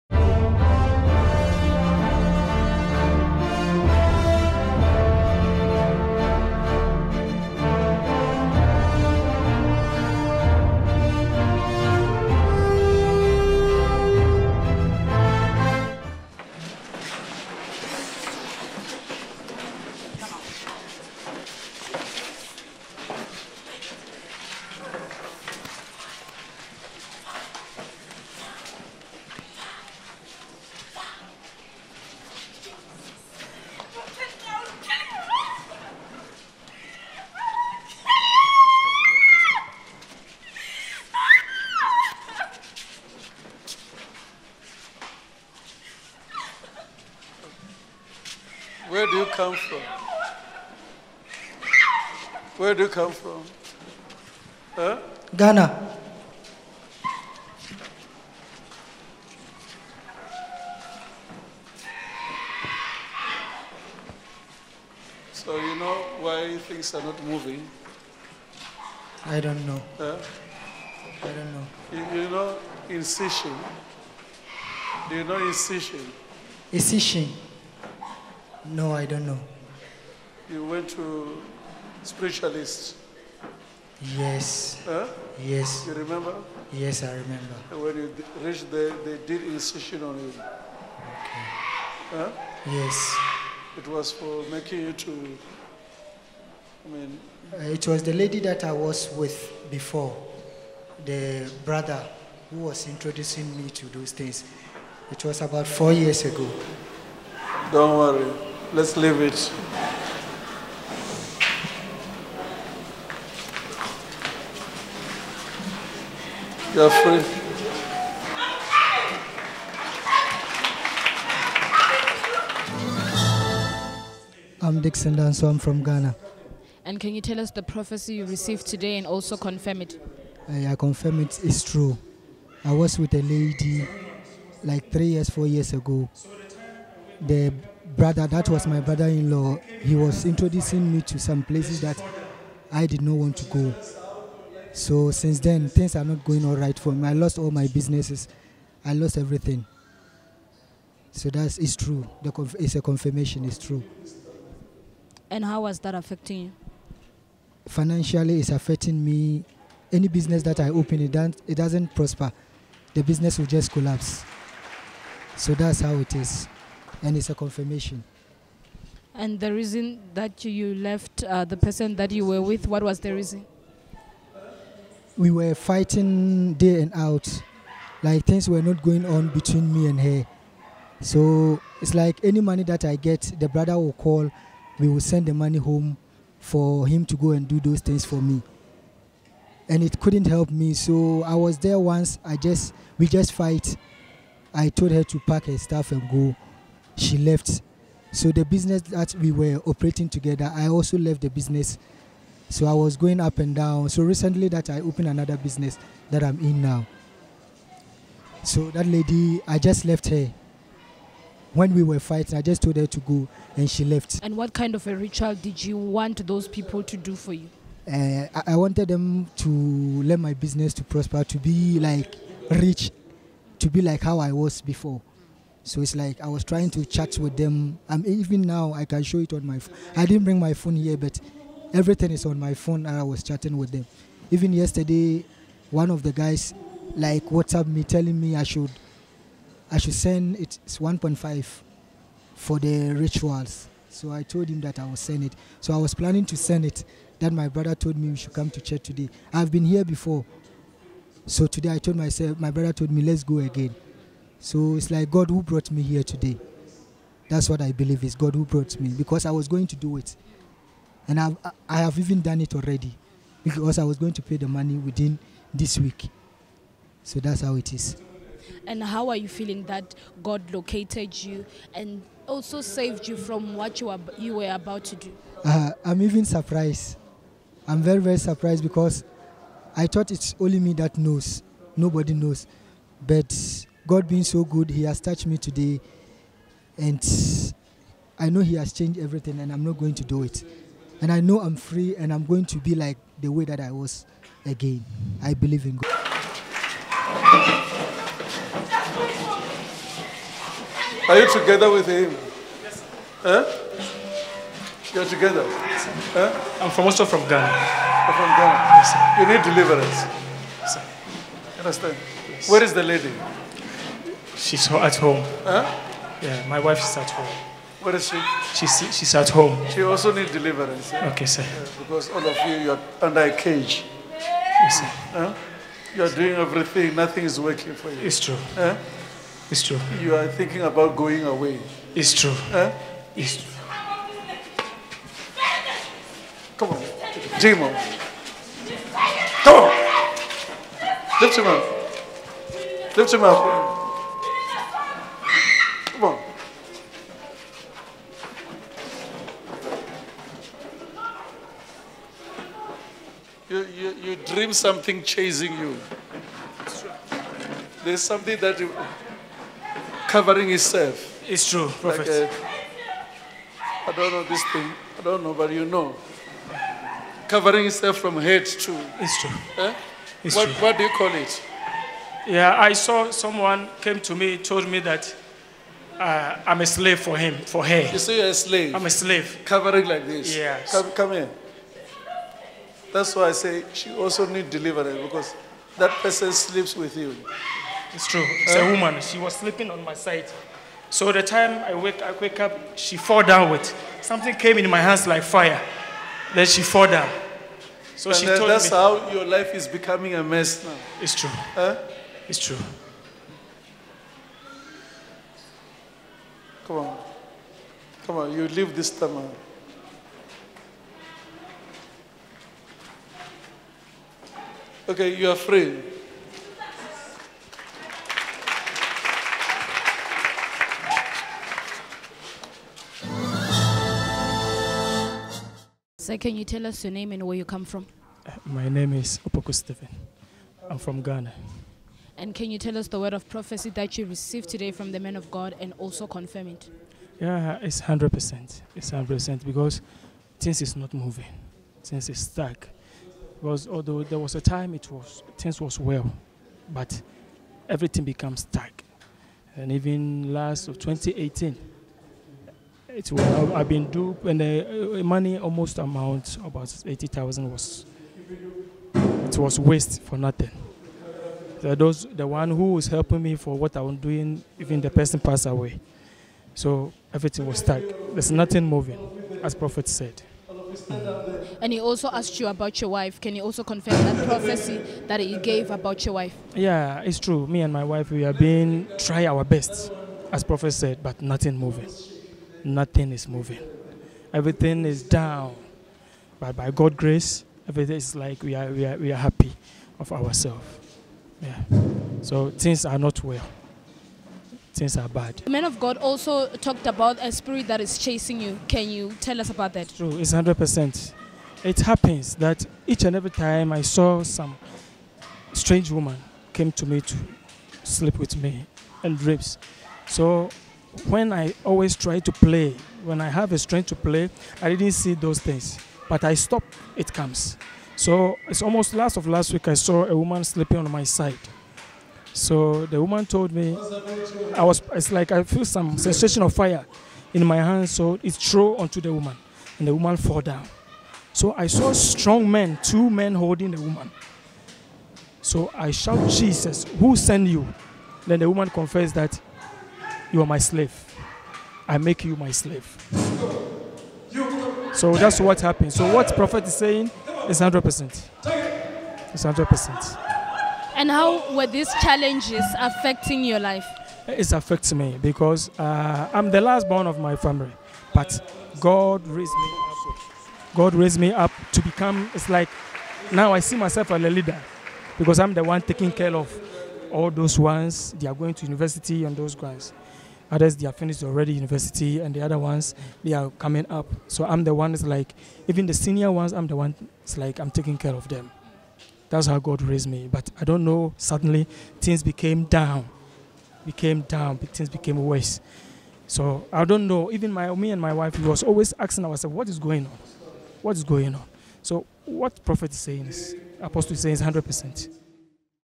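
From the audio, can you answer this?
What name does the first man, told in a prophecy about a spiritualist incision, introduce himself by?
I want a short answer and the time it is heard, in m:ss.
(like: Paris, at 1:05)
Dixon Danso, at 2:04.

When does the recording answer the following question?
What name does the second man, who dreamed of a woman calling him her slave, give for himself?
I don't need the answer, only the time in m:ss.
7:09.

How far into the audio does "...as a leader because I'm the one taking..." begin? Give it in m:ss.
9:24.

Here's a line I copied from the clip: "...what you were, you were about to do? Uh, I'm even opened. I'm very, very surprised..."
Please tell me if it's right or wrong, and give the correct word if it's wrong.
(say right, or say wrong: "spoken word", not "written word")
wrong: "surprised", not "opened".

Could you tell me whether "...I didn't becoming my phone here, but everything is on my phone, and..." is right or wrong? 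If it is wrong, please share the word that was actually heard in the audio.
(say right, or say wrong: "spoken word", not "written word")
wrong: "bring", not "becoming".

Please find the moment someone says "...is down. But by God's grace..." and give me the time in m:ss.
8:04.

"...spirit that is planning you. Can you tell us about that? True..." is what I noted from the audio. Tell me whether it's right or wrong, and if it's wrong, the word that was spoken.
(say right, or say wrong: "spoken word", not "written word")
wrong: "chasing", not "planning".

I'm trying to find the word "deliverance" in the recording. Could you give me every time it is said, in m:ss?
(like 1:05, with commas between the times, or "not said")
5:09, 5:20, 6:24.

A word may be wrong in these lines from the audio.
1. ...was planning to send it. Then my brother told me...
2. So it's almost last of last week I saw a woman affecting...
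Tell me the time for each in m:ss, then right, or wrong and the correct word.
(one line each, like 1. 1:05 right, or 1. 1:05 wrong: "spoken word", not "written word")
1. 4:05 right
2. 8:37 wrong: "sleeping", not "affecting".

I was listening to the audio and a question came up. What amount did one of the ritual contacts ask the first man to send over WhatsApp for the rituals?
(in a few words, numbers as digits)
1.5.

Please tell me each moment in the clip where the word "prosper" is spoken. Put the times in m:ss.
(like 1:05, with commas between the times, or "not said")
2:41, 3:40.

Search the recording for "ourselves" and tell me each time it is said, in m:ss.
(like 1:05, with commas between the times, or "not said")
8:10, 9:49.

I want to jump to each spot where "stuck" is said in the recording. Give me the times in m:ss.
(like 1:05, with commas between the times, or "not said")
7:22, 7:28, 7:47.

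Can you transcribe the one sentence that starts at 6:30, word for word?
So the time I wake, I wake up, she fall down with something came in my hands like fire.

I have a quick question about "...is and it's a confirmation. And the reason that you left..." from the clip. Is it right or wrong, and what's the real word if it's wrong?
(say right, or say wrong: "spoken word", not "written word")
right.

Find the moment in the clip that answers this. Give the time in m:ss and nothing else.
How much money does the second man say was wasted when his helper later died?
7:36.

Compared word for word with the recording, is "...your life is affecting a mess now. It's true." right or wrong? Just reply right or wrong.
wrong.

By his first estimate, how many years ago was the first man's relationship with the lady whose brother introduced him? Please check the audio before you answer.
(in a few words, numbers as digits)
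3 years.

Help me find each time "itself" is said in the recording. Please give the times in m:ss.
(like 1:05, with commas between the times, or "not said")
6:00, 6:07.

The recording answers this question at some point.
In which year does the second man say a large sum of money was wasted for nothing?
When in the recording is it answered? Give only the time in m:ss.
7:30.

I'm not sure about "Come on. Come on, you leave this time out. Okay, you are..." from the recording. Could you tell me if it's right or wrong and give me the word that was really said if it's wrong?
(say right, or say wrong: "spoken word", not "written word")
right.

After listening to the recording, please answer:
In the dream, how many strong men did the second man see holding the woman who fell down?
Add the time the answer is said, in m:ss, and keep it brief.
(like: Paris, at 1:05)
2, at 8:52.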